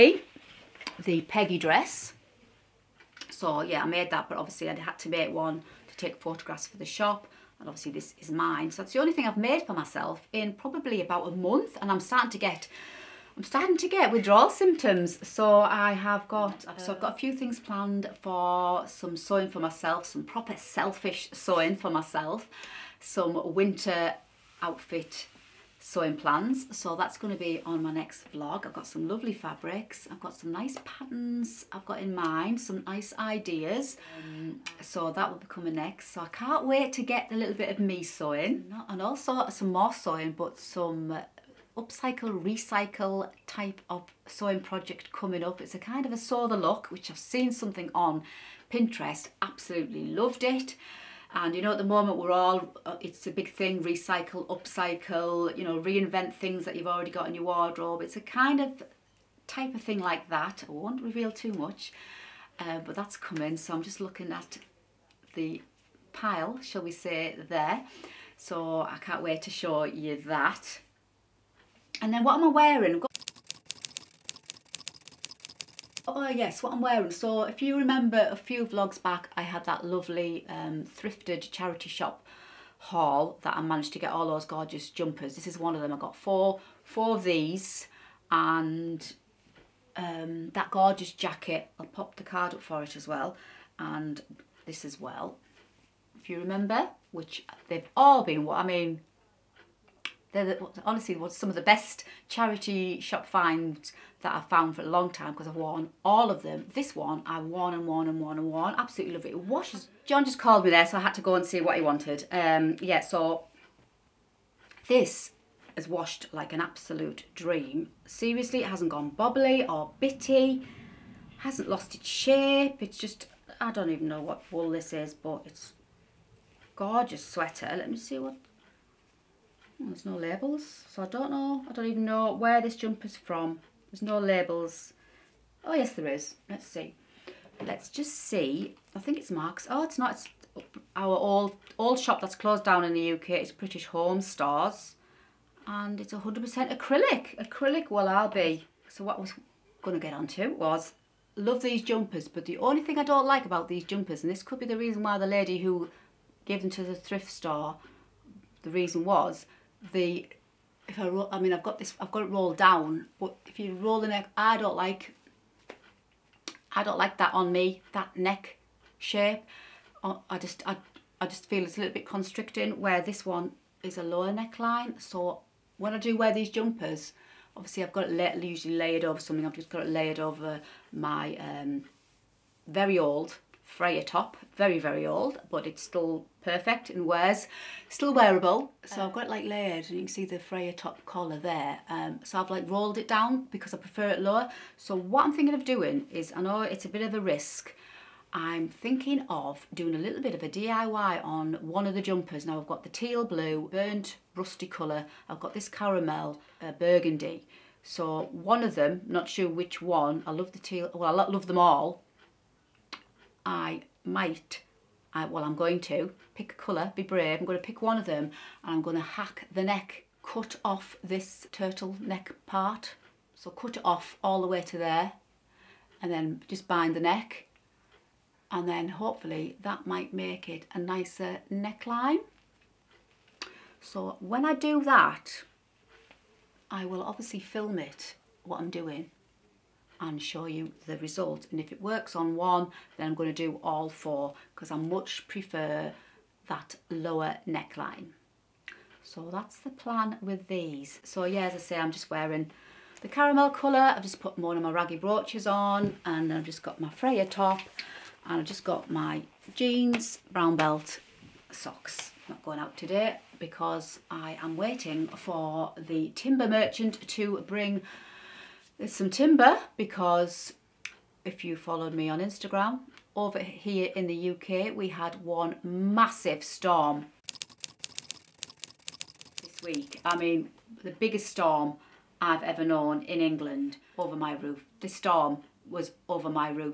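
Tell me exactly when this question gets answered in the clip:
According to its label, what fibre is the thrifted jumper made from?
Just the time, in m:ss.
2:26.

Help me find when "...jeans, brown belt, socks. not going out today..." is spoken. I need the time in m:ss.
4:19.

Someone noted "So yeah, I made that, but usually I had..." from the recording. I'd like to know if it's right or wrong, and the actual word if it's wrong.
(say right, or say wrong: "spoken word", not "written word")
wrong: "obviously", not "usually".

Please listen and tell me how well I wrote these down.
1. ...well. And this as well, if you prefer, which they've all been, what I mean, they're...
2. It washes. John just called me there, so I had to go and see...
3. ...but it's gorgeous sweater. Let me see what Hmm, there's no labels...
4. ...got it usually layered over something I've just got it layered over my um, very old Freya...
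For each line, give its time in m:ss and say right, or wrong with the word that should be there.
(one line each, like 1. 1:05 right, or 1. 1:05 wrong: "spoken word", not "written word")
1. 1:33 wrong: "remember", not "prefer"
2. 1:49 right
3. 2:05 right
4. 2:57 right.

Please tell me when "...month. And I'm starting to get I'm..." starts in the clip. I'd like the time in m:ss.
0:11.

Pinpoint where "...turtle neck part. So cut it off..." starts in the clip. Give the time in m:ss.
3:41.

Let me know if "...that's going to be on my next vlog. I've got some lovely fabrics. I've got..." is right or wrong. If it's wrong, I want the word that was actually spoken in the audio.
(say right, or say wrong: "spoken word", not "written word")
right.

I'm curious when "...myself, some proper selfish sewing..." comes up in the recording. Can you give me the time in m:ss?
0:19.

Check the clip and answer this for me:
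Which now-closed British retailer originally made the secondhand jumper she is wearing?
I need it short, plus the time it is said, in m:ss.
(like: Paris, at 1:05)
British Home Stores, at 2:23.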